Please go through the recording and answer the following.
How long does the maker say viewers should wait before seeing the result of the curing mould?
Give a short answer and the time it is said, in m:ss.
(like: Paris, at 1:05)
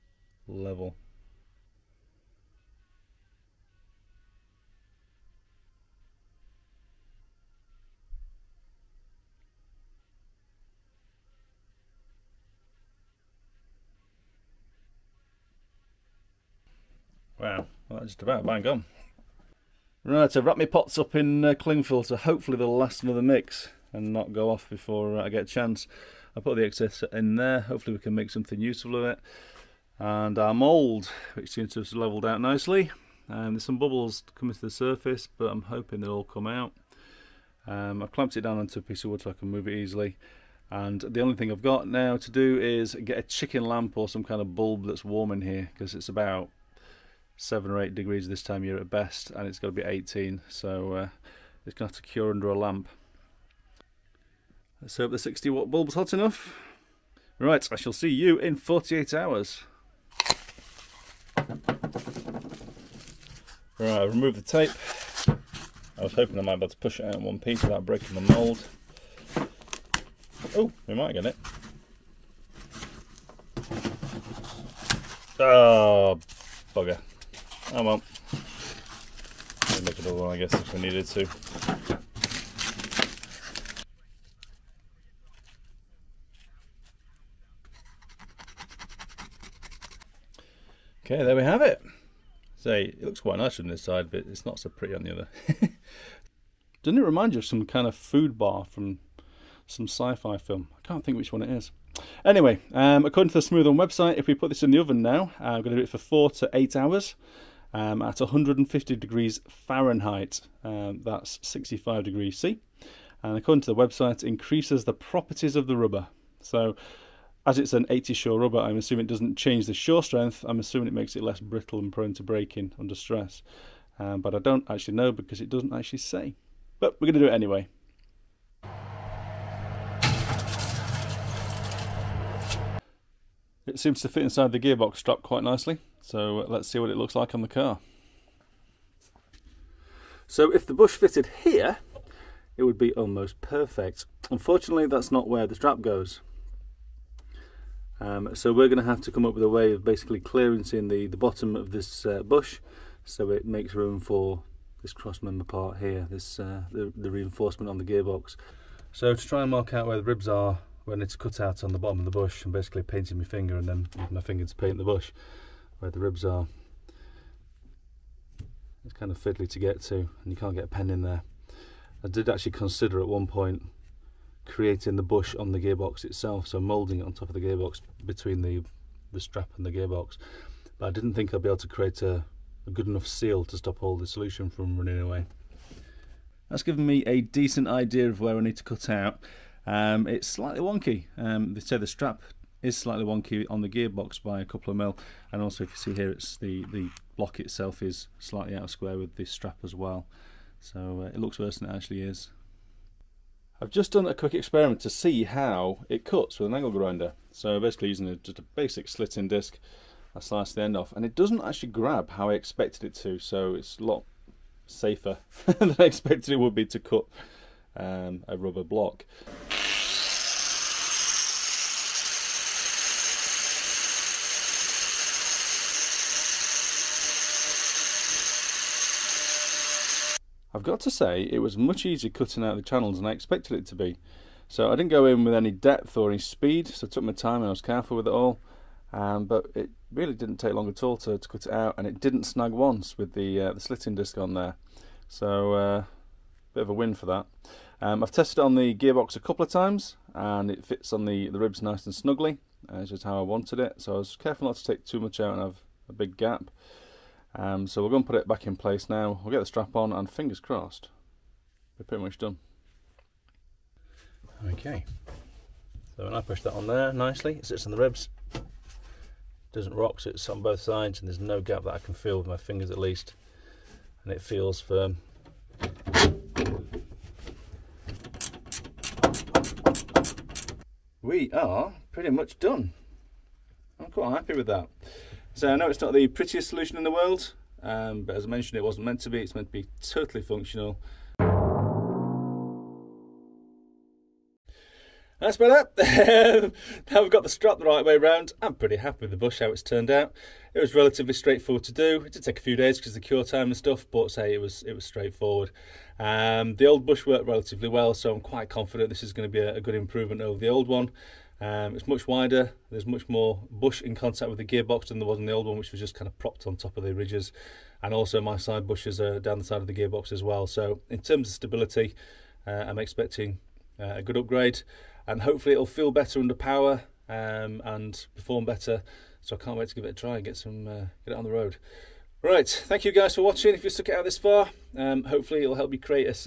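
48 hours, at 0:58.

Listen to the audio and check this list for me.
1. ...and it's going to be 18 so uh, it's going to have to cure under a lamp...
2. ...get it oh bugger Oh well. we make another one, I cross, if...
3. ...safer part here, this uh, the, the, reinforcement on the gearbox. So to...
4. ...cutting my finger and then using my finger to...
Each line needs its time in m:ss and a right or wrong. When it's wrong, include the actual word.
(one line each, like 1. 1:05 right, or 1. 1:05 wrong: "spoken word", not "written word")
1. 0:49 right
2. 1:11 wrong: "guess", not "cross"
3. 2:35 wrong: "member", not "safer"
4. 2:42 wrong: "painting", not "cutting".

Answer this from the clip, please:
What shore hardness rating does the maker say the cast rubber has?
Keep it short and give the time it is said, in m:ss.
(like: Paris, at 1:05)
80 shore, at 1:57.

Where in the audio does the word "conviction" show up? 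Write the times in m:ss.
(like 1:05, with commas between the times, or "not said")
not said.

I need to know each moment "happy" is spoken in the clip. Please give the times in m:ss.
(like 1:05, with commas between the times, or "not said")
4:44, 4:58.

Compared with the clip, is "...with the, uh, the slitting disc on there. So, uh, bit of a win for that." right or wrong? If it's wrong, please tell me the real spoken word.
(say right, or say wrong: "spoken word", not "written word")
right.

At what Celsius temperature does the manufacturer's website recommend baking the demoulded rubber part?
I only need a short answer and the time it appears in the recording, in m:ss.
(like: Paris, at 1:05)
65 degrees C, at 1:51.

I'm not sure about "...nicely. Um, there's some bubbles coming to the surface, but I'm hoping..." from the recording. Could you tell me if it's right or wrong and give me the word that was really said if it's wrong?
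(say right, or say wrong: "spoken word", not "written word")
right.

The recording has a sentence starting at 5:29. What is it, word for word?
So I can't wait to give it a try and get, some, uh, get it on the road.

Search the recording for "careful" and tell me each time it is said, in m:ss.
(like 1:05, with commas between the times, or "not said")
3:57, 4:14.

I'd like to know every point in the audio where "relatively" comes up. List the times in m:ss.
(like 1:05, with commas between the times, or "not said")
5:00, 5:07.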